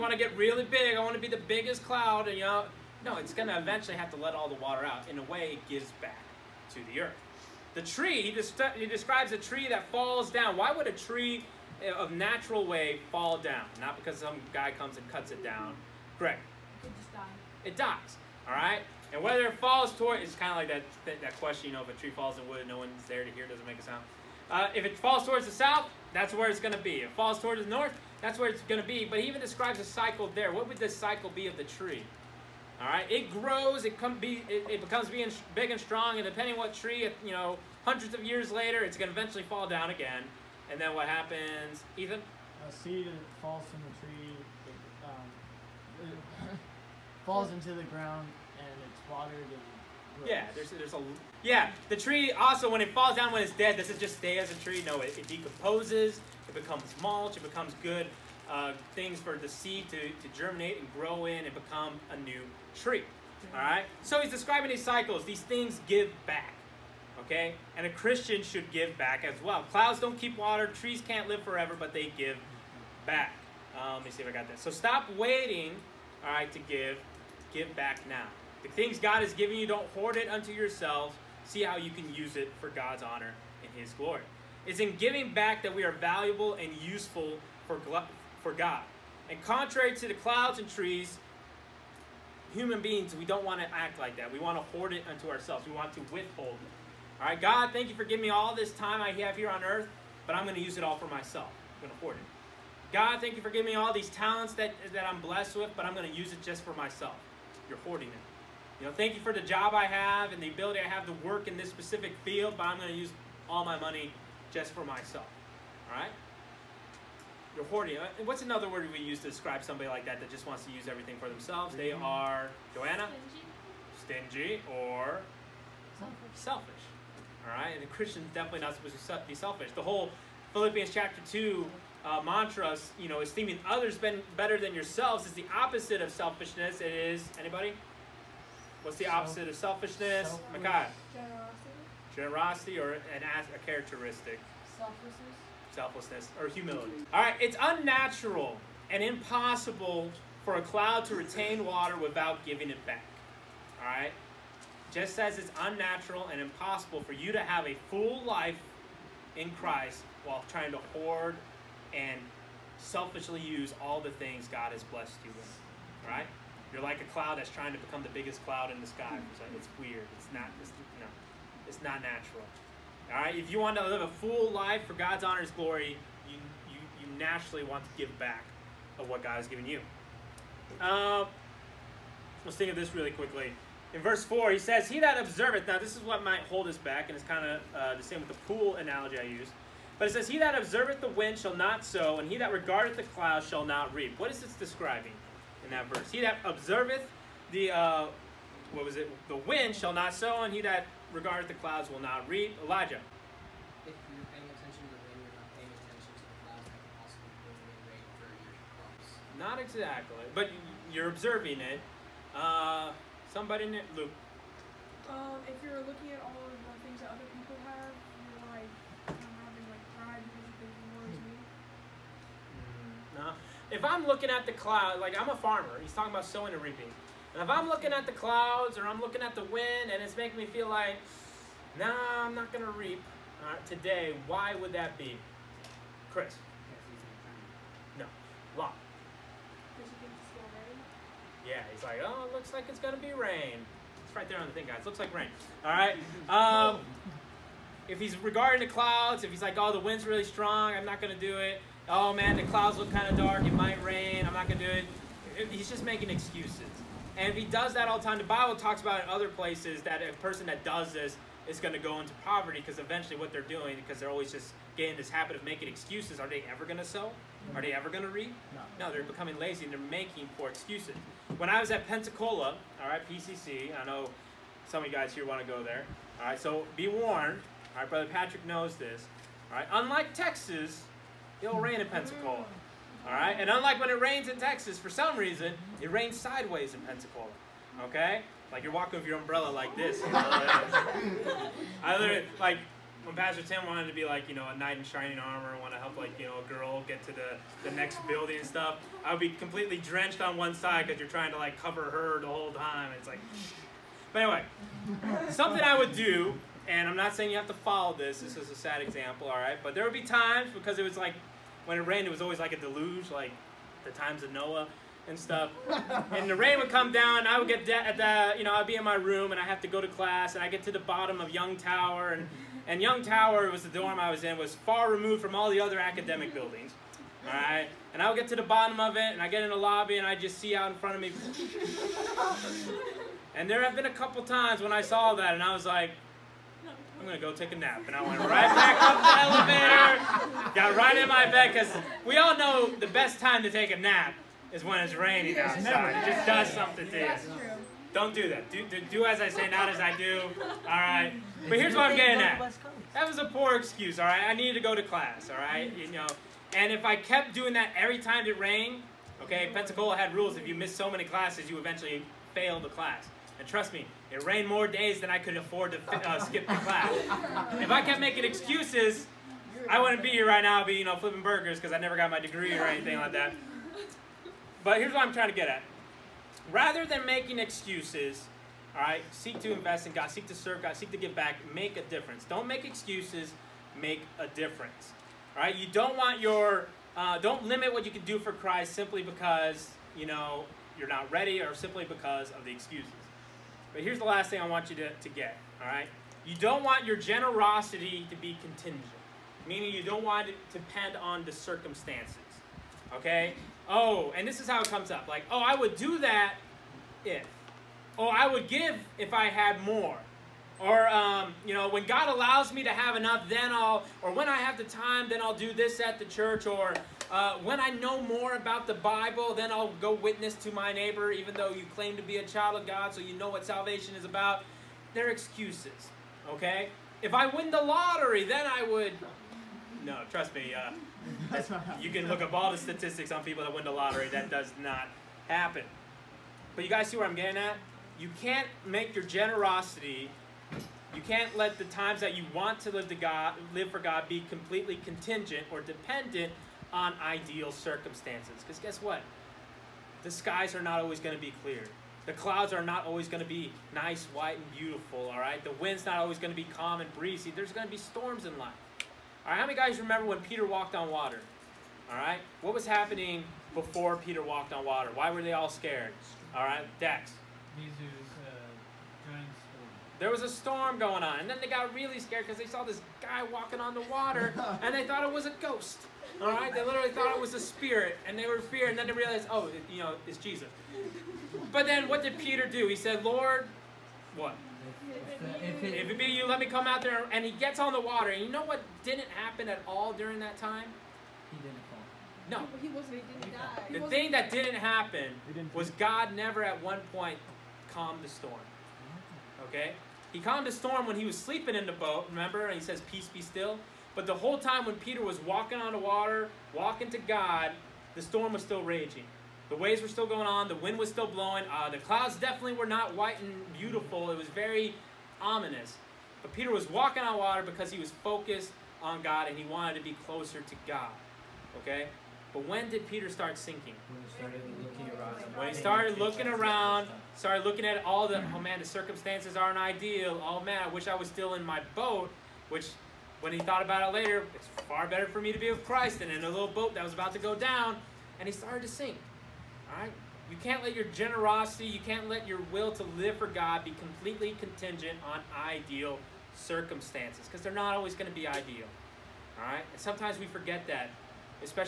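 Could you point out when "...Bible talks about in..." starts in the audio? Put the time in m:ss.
4:18.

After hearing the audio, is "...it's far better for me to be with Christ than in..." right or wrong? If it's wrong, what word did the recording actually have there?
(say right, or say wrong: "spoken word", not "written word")
right.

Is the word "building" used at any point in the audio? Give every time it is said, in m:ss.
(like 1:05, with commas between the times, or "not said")
4:58, 5:26.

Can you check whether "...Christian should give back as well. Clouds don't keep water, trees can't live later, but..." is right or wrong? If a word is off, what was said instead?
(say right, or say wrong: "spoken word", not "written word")
wrong: "forever", not "later".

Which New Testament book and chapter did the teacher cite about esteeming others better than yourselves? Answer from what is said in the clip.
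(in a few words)
Philippians chapter 2.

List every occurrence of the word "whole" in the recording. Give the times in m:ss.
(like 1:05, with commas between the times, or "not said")
2:09, 5:02, 8:24.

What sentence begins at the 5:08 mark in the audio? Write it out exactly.
This is a sad example, all right.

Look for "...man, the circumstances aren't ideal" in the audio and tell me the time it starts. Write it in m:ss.
8:48.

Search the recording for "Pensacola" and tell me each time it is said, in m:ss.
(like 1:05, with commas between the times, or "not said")
4:31, 4:41, 4:46, 5:59.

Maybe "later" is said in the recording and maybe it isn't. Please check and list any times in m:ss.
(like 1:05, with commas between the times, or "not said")
0:38, 8:53.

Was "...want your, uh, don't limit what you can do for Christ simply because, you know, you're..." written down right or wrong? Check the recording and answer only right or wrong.
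right.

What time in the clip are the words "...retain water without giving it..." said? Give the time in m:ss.
2:31.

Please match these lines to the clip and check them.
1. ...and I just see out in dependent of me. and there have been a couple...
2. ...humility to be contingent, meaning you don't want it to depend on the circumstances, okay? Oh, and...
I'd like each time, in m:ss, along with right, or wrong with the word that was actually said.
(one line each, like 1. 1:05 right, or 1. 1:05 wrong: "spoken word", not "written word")
1. 5:29 wrong: "front", not "dependent"
2. 6:36 wrong: "generosity", not "humility".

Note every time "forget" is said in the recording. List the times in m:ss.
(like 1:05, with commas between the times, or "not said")
9:10.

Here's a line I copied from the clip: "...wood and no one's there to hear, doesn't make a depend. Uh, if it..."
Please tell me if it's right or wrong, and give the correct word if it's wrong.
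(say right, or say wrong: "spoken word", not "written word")
wrong: "sound", not "depend".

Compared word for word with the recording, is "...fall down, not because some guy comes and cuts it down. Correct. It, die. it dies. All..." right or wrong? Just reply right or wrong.
right.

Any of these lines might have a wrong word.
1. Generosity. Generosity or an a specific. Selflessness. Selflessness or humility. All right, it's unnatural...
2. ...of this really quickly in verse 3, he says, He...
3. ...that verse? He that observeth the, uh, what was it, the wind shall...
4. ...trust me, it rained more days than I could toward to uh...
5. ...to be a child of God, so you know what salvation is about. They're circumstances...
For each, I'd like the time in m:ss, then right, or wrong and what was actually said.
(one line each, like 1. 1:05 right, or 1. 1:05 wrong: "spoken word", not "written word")
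1. 2:21 wrong: "characteristic", not "specific"
2. 3:02 wrong: "4", not "3"
3. 3:15 right
4. 6:03 wrong: "afford", not "toward"
5. 7:01 wrong: "excuses", not "circumstances".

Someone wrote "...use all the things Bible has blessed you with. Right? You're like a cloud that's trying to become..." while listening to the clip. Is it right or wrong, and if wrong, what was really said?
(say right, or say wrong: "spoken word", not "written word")
wrong: "God", not "Bible".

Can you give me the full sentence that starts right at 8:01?
But then, what did Peter do?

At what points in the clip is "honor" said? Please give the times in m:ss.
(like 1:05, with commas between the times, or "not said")
1:23, 2:55.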